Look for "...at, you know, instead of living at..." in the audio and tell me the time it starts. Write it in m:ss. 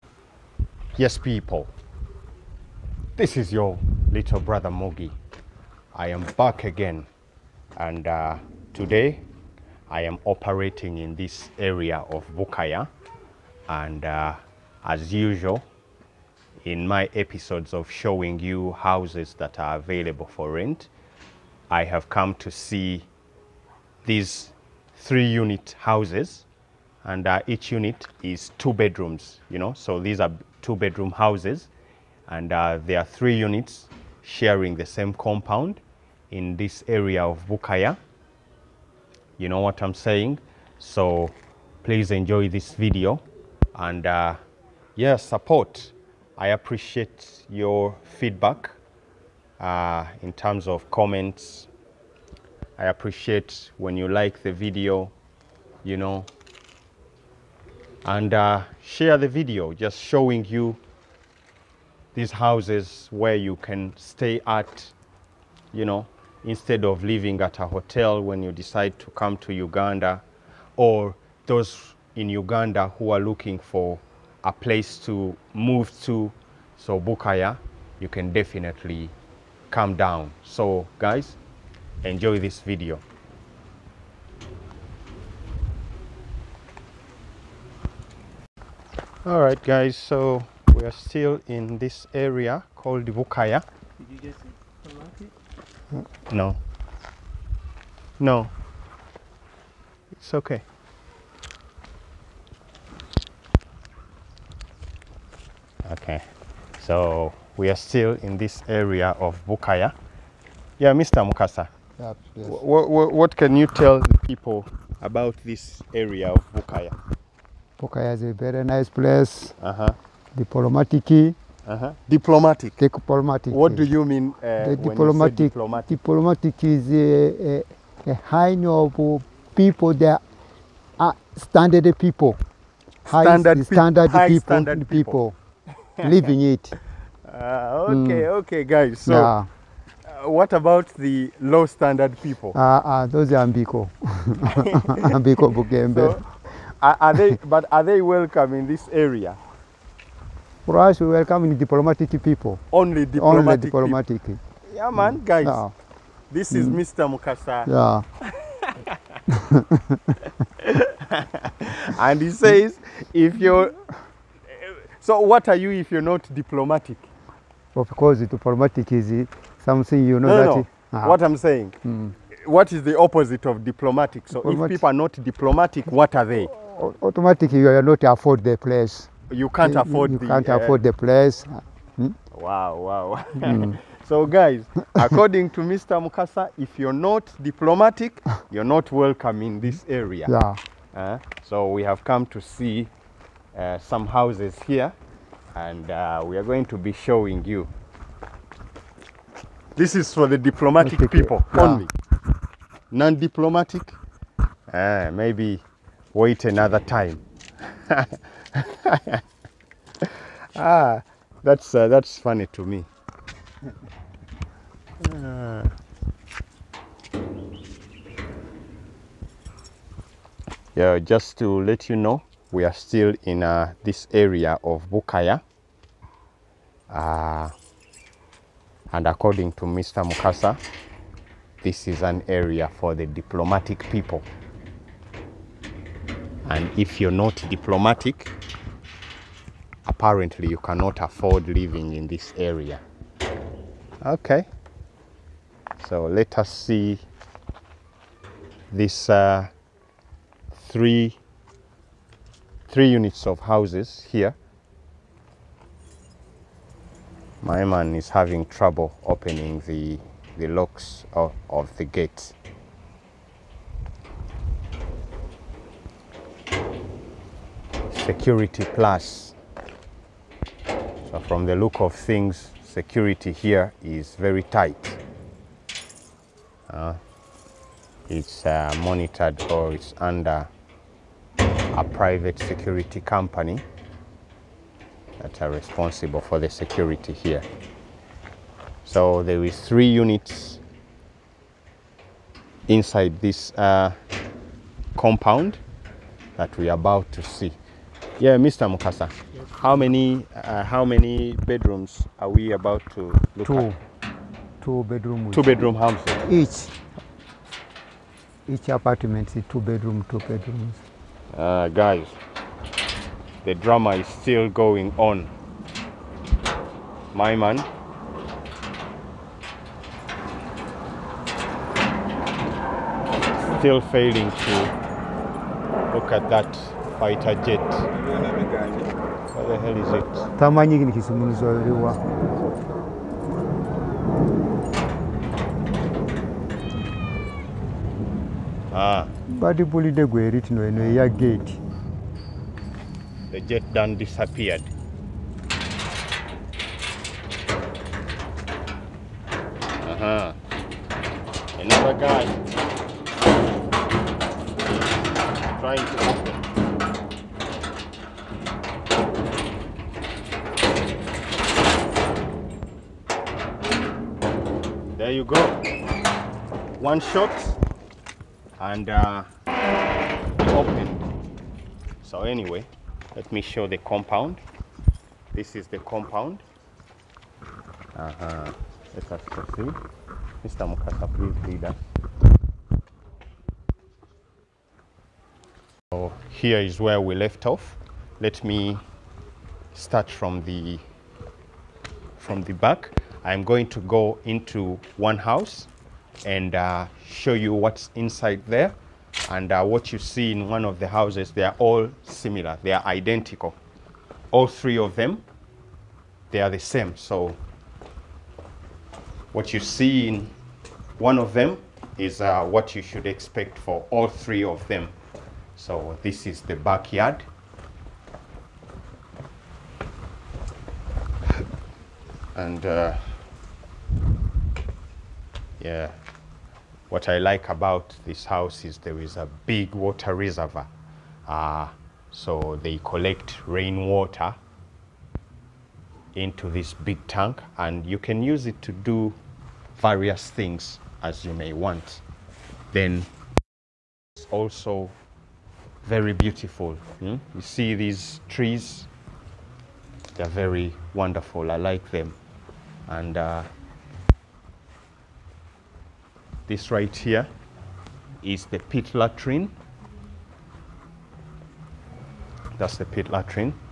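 1:04.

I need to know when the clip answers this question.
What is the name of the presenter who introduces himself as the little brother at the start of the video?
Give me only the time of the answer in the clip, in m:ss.
0:04.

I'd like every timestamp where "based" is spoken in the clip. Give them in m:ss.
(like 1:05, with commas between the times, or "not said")
not said.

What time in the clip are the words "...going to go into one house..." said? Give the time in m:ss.
6:33.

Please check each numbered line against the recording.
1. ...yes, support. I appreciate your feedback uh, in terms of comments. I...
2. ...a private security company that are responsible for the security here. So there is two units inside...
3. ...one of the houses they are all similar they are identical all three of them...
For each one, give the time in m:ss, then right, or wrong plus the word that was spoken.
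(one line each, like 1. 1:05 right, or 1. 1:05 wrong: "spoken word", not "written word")
1. 0:44 right
2. 4:41 wrong: "three", not "two"
3. 6:40 right.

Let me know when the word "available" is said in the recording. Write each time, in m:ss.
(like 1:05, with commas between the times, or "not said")
0:19.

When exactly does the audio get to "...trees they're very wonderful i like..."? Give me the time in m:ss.
7:28.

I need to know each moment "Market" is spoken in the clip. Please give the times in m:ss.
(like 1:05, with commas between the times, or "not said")
1:35.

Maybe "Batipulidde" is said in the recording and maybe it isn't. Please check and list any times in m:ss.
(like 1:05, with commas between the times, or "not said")
5:39.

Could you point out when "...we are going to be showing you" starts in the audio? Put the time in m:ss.
3:16.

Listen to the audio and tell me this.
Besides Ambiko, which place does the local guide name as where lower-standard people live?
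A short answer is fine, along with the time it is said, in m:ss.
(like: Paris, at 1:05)
Bugembe, at 2:25.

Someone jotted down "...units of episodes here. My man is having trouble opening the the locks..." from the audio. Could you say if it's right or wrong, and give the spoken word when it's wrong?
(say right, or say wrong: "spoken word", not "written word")
wrong: "houses", not "episodes".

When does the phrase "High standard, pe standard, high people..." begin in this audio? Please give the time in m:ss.
2:13.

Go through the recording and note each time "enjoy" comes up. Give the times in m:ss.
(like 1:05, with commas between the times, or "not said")
0:42, 1:22.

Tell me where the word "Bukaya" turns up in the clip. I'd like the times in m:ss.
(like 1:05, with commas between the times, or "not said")
0:12, 0:37, 1:16, 1:33, 1:49, 1:56, 3:44.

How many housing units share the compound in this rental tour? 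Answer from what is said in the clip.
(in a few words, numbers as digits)
3.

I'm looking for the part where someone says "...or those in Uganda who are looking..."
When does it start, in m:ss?
1:10.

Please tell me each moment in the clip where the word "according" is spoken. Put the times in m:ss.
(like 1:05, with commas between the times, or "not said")
3:04, 3:49.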